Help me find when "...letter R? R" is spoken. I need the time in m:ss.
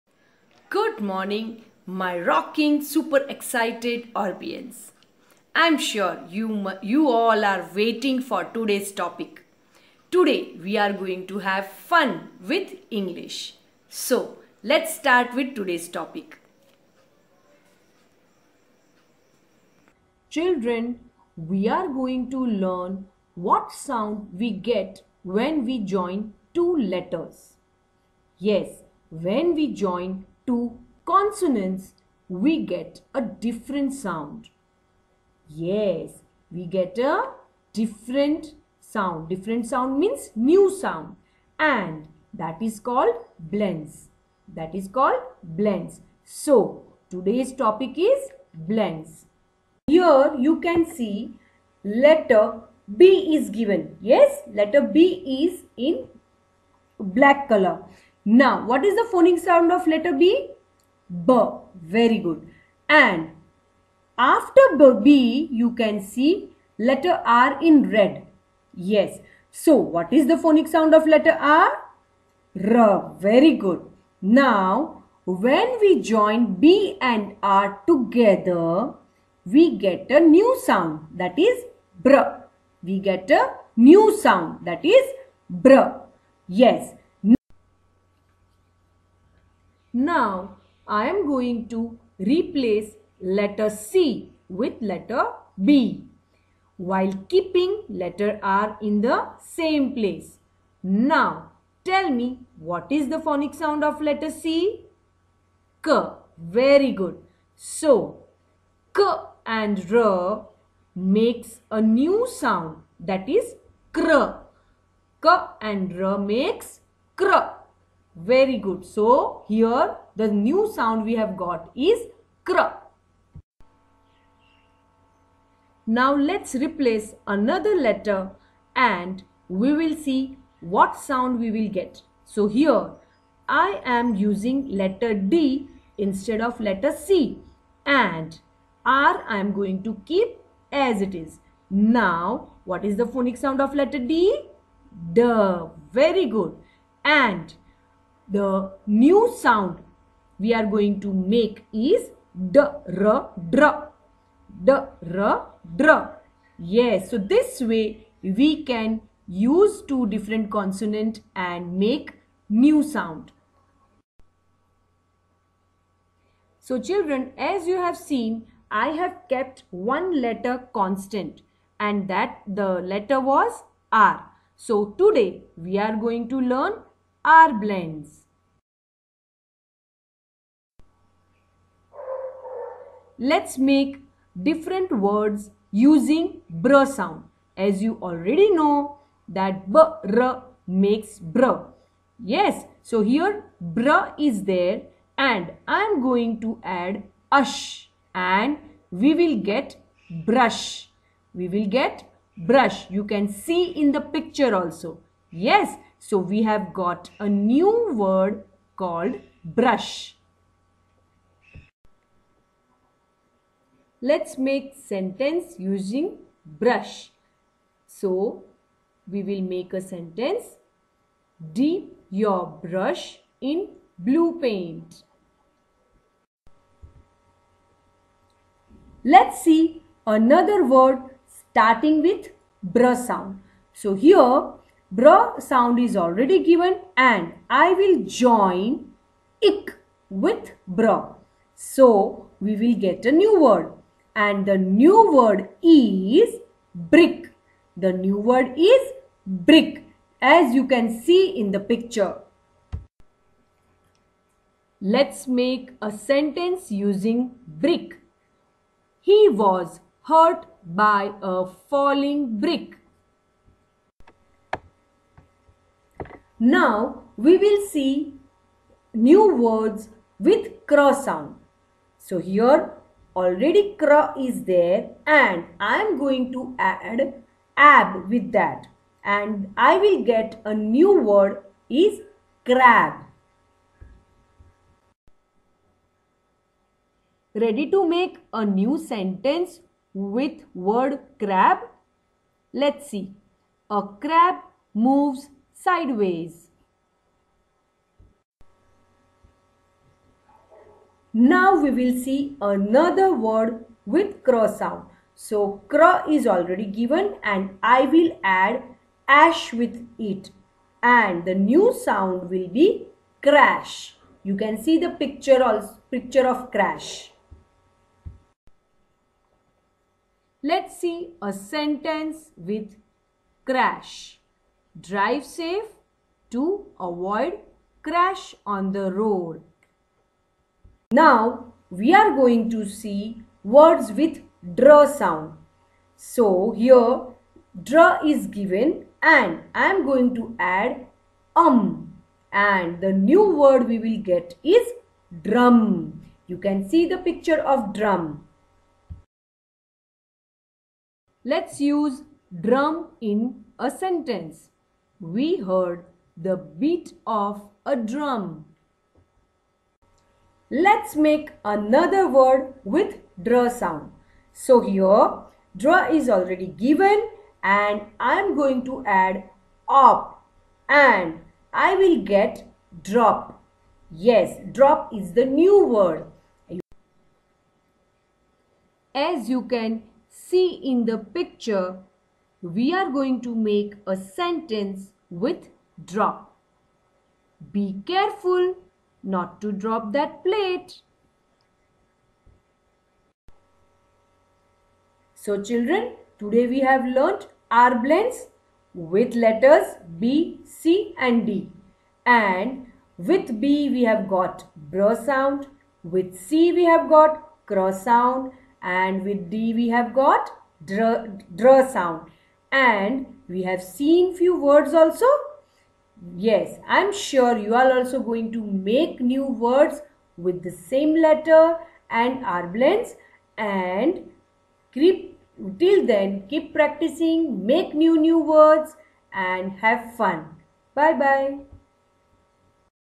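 1:11.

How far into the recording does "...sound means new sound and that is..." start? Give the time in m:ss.
0:39.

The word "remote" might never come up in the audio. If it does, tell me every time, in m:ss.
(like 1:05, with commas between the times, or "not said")
not said.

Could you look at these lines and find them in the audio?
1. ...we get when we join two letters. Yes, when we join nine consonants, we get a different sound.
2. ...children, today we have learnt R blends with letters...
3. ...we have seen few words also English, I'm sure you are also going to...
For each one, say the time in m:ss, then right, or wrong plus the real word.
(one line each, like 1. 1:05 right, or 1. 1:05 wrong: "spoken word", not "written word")
1. 0:24 wrong: "two", not "nine"
2. 6:35 right
3. 6:53 wrong: "Yes", not "English".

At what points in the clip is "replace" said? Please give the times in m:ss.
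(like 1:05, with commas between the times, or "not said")
1:32, 2:06.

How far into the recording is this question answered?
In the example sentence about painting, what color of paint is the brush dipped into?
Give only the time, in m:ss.
3:41.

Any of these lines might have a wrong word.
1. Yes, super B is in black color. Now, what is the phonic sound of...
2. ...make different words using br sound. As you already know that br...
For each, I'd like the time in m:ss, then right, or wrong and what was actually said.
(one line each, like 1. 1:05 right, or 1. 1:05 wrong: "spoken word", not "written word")
1. 0:54 wrong: "letter", not "super"
2. 3:03 right.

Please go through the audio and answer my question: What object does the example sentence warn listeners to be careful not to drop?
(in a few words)
that plate.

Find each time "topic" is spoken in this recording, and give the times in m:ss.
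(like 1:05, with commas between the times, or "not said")
0:08, 0:15, 0:47.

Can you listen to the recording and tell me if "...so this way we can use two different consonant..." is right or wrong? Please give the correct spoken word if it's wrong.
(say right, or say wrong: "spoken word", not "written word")
right.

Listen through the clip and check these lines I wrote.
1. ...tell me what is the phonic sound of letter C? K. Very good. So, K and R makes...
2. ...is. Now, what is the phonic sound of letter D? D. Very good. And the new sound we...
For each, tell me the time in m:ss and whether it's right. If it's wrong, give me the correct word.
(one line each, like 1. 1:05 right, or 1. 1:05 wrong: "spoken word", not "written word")
1. 1:41 right
2. 2:21 right.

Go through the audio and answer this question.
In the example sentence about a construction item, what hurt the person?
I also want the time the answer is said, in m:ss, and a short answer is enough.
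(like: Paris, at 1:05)
a falling brick, at 4:18.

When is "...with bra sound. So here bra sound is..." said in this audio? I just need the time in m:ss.
3:52.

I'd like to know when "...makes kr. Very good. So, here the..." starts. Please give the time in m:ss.
1:56.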